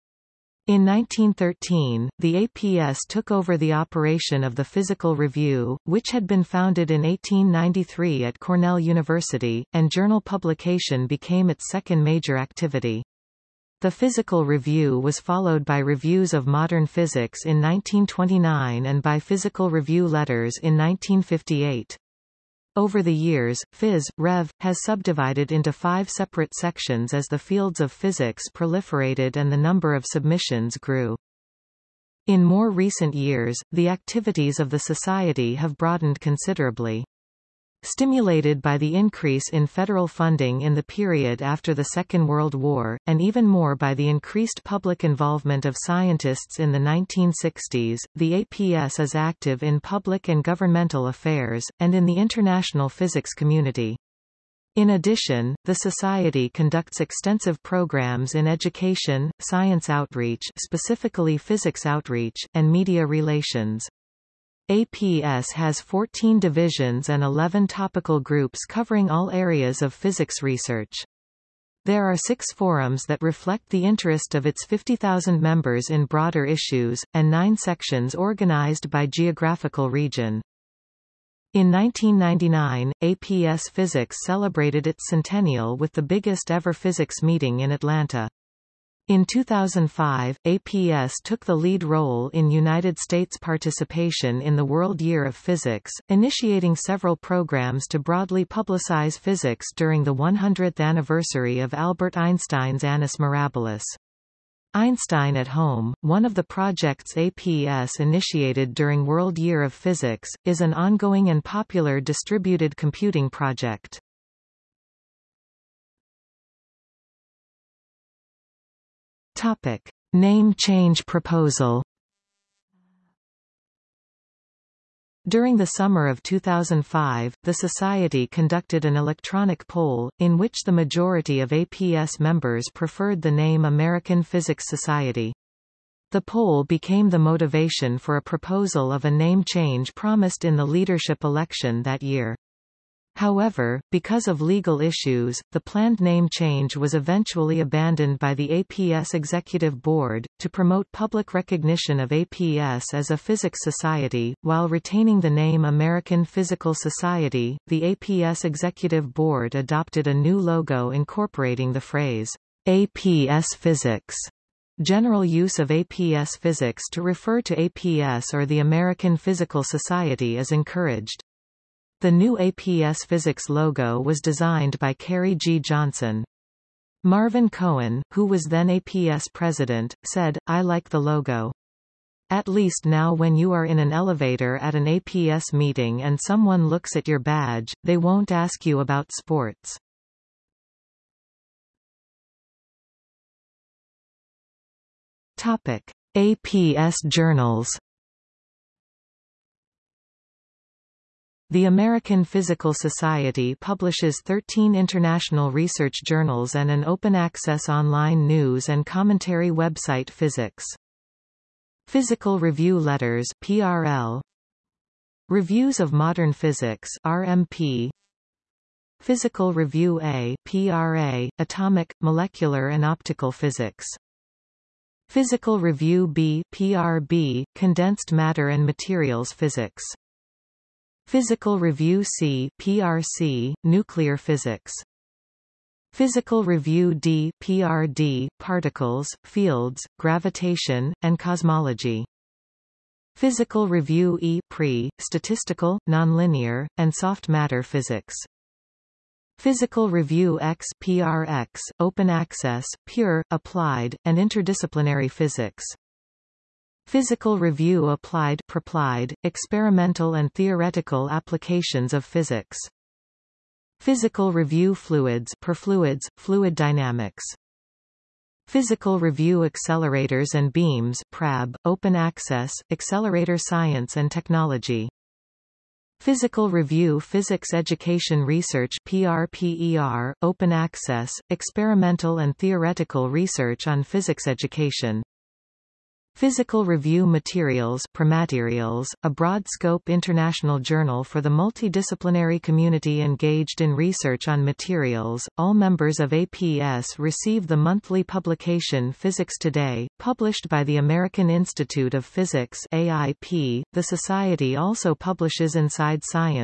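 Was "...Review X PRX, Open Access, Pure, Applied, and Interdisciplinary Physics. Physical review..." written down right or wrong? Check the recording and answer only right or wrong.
right.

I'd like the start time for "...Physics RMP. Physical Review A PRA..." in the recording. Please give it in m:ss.
3:36.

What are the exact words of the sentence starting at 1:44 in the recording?
Einstein at Home, one of the projects APS initiated during World Year of Physics, is an ongoing and popular distributed computing project.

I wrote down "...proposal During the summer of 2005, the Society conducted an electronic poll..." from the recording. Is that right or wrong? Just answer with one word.
right.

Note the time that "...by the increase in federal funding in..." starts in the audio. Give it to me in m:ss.
0:38.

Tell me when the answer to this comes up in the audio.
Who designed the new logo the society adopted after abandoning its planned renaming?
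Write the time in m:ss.
2:54.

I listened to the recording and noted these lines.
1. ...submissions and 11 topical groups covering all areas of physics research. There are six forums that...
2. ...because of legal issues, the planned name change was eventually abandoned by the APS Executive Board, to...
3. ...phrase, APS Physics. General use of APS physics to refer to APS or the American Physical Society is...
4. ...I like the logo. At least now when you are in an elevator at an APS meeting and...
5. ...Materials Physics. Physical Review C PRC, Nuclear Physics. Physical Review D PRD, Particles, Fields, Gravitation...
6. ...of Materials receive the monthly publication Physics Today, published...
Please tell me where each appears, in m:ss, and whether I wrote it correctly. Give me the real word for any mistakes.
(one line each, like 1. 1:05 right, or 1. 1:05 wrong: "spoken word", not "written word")
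1. 1:06 wrong: "divisions", not "submissions"
2. 2:23 right
3. 2:41 right
4. 3:00 right
5. 3:48 right
6. 4:56 wrong: "APS", not "Materials".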